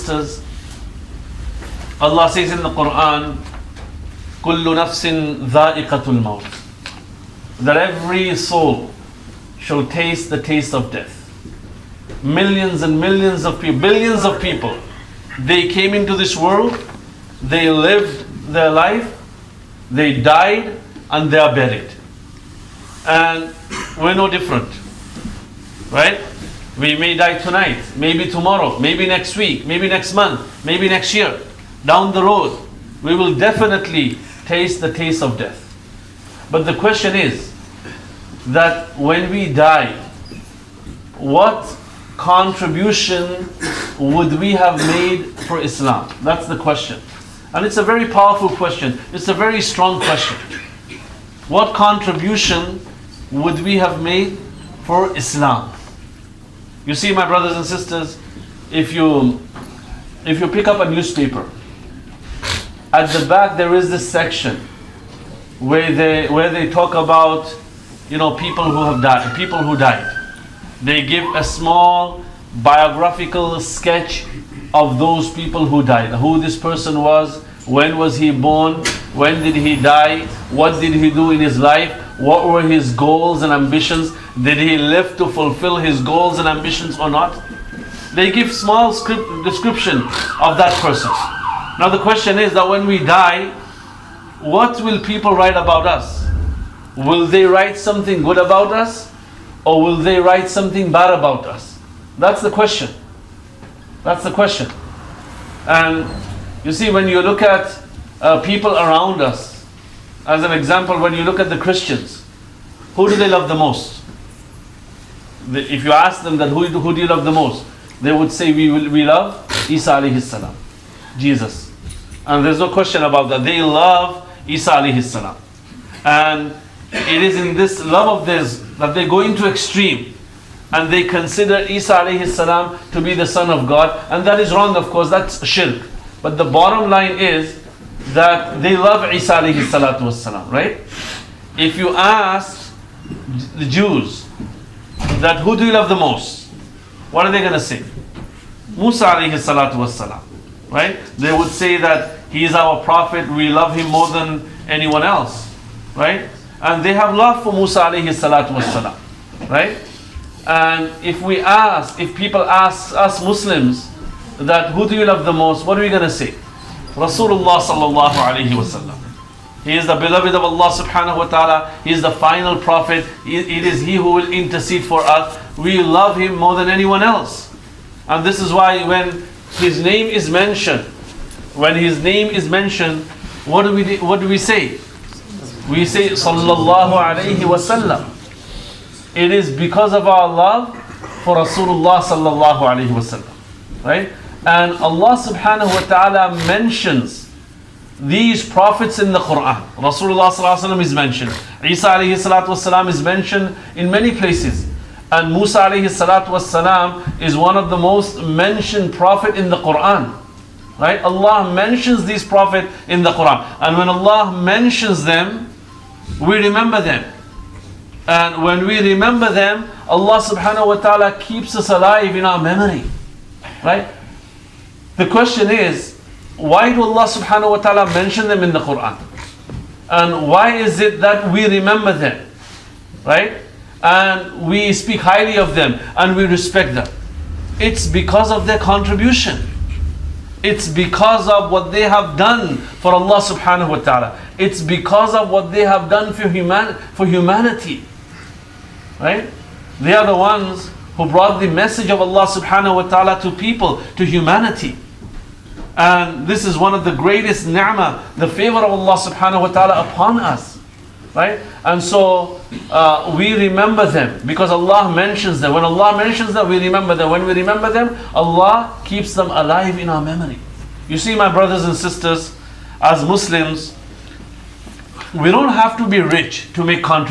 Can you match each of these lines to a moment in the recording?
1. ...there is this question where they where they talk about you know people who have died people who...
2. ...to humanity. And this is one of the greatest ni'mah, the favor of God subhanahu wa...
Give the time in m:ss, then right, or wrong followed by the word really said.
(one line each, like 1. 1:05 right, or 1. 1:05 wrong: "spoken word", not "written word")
1. 1:03 wrong: "section", not "question"
2. 4:13 wrong: "Allah", not "God".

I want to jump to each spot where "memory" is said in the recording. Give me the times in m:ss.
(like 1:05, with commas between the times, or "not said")
3:42, 4:30.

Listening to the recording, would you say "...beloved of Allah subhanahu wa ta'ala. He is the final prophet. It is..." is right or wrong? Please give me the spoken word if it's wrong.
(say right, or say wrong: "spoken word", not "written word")
right.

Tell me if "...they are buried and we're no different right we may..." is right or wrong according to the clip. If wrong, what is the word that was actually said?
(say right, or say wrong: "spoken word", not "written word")
right.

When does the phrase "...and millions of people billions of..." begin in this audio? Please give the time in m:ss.
0:12.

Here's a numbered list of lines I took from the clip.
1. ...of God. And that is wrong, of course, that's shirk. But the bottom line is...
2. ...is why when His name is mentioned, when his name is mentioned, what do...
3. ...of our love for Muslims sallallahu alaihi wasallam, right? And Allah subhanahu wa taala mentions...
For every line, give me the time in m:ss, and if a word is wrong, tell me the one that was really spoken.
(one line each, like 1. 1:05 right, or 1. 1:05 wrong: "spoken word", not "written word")
1. 2:13 right
2. 2:58 right
3. 3:09 wrong: "Rasulullah", not "Muslims".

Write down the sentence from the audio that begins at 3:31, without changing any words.
Allah mentions these Prophet in the Quran.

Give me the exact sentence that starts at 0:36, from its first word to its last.
But the question is that when we die, what contribution would we have made for Islam?